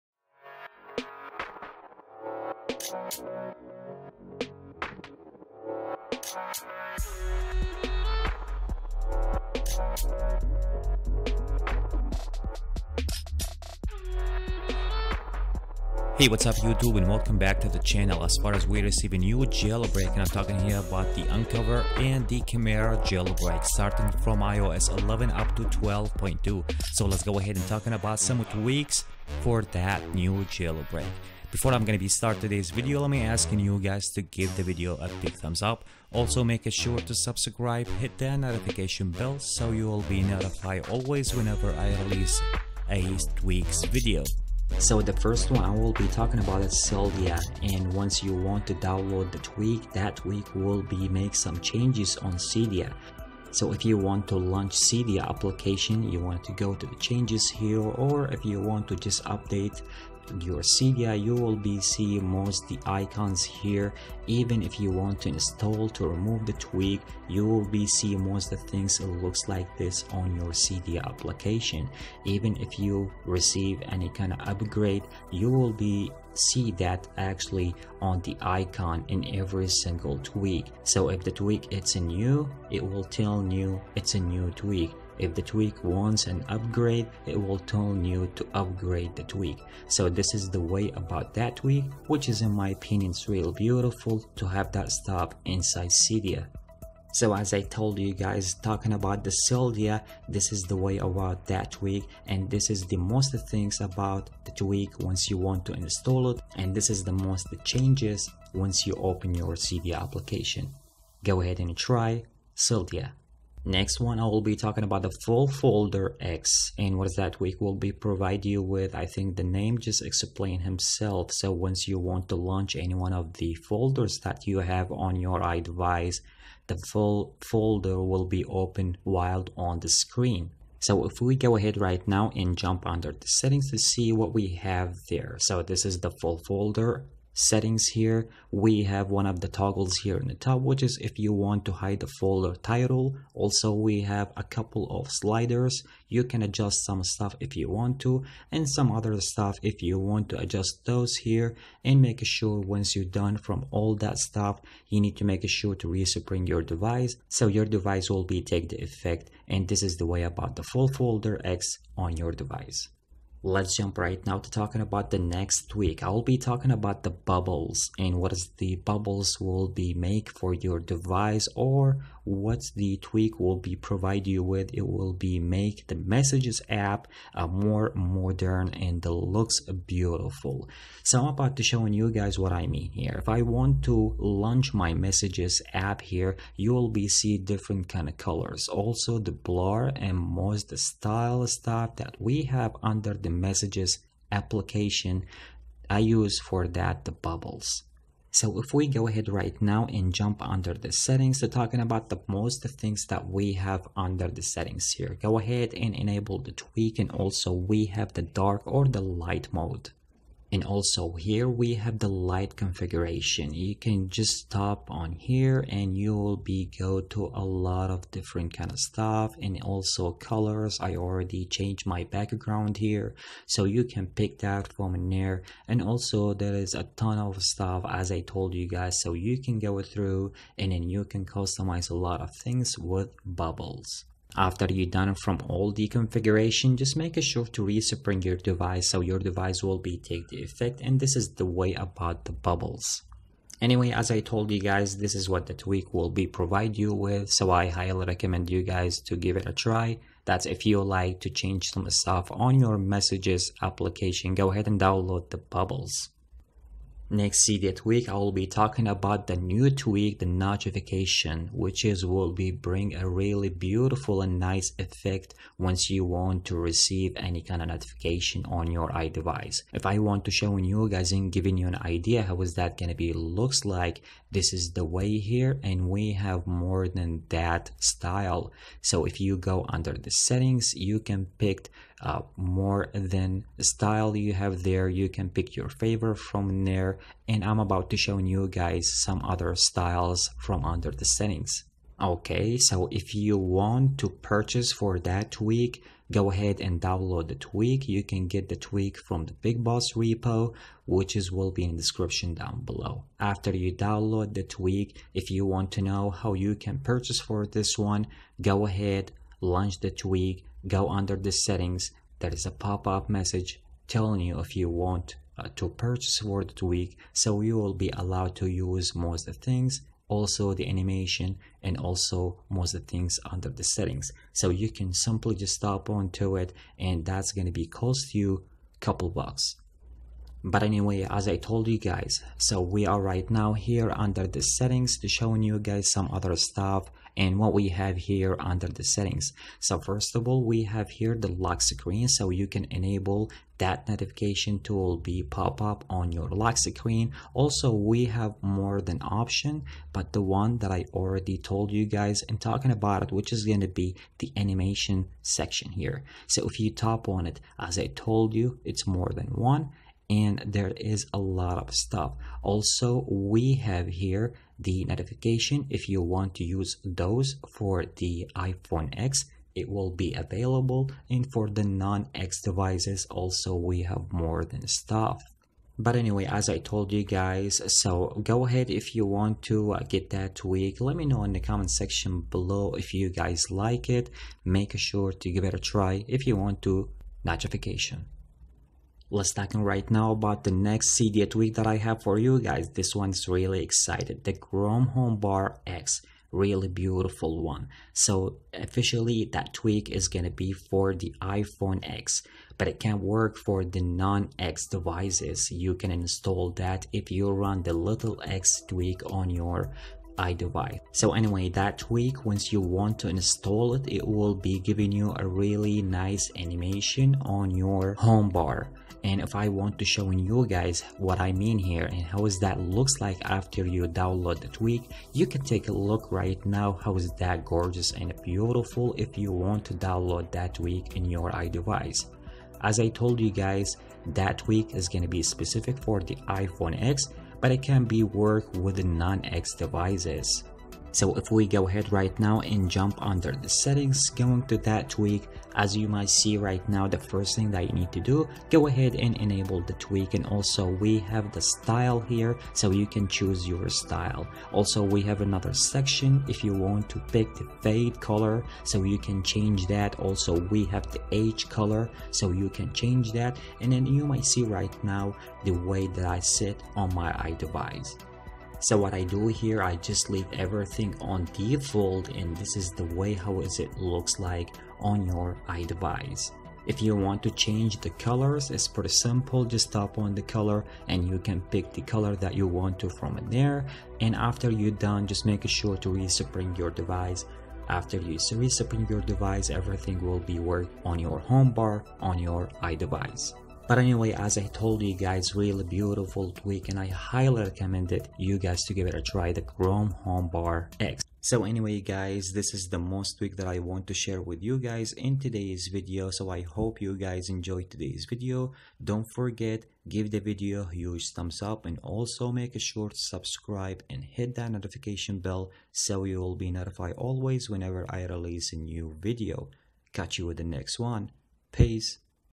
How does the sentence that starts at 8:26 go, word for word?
So I hope you guys enjoyed today's video.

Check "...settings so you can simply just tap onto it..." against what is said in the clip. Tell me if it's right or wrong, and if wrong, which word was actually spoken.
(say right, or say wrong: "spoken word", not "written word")
right.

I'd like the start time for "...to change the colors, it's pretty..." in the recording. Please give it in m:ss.
7:57.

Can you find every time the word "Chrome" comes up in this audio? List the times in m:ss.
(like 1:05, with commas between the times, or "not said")
6:34, 8:19.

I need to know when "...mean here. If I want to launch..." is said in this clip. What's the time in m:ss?
3:02.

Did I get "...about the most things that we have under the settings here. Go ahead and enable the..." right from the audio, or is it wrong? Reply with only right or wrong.
right.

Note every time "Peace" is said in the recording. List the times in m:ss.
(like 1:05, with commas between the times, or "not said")
8:41.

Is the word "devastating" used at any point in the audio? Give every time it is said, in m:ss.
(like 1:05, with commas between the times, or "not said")
not said.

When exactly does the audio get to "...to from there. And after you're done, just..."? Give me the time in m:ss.
8:02.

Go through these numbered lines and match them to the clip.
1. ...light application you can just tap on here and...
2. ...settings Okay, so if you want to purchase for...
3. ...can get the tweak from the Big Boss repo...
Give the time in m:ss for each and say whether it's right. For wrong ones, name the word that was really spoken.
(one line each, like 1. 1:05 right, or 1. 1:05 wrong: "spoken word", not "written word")
1. 3:32 wrong: "configuration", not "application"
2. 4:51 right
3. 4:58 right.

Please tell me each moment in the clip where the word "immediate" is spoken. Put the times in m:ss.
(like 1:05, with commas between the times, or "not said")
4:17.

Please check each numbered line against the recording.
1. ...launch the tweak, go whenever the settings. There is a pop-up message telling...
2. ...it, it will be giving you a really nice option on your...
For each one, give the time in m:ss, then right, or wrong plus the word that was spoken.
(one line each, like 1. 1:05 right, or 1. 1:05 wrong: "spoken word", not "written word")
1. 5:09 wrong: "under", not "whenever"
2. 6:53 wrong: "animation", not "option".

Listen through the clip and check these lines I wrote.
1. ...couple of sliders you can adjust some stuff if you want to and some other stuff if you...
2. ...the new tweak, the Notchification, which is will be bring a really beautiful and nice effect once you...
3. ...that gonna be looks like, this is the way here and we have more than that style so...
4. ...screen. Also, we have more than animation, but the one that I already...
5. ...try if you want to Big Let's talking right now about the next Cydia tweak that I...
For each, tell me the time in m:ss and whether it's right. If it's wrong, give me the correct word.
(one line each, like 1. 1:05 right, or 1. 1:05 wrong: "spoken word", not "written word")
1. 2:24 right
2. 4:19 right
3. 4:32 right
4. 5:46 wrong: "option", not "animation"
5. 6:25 wrong: "Notchification", not "Big".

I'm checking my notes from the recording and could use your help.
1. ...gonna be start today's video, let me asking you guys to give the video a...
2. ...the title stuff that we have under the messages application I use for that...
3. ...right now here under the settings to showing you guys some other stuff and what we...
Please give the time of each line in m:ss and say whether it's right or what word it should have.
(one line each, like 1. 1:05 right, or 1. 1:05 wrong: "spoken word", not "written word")
1. 0:31 right
2. 3:10 wrong: "style", not "title"
3. 5:32 right.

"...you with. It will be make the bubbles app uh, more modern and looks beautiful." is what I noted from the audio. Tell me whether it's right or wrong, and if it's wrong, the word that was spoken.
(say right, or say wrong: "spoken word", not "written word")
wrong: "messages", not "bubbles".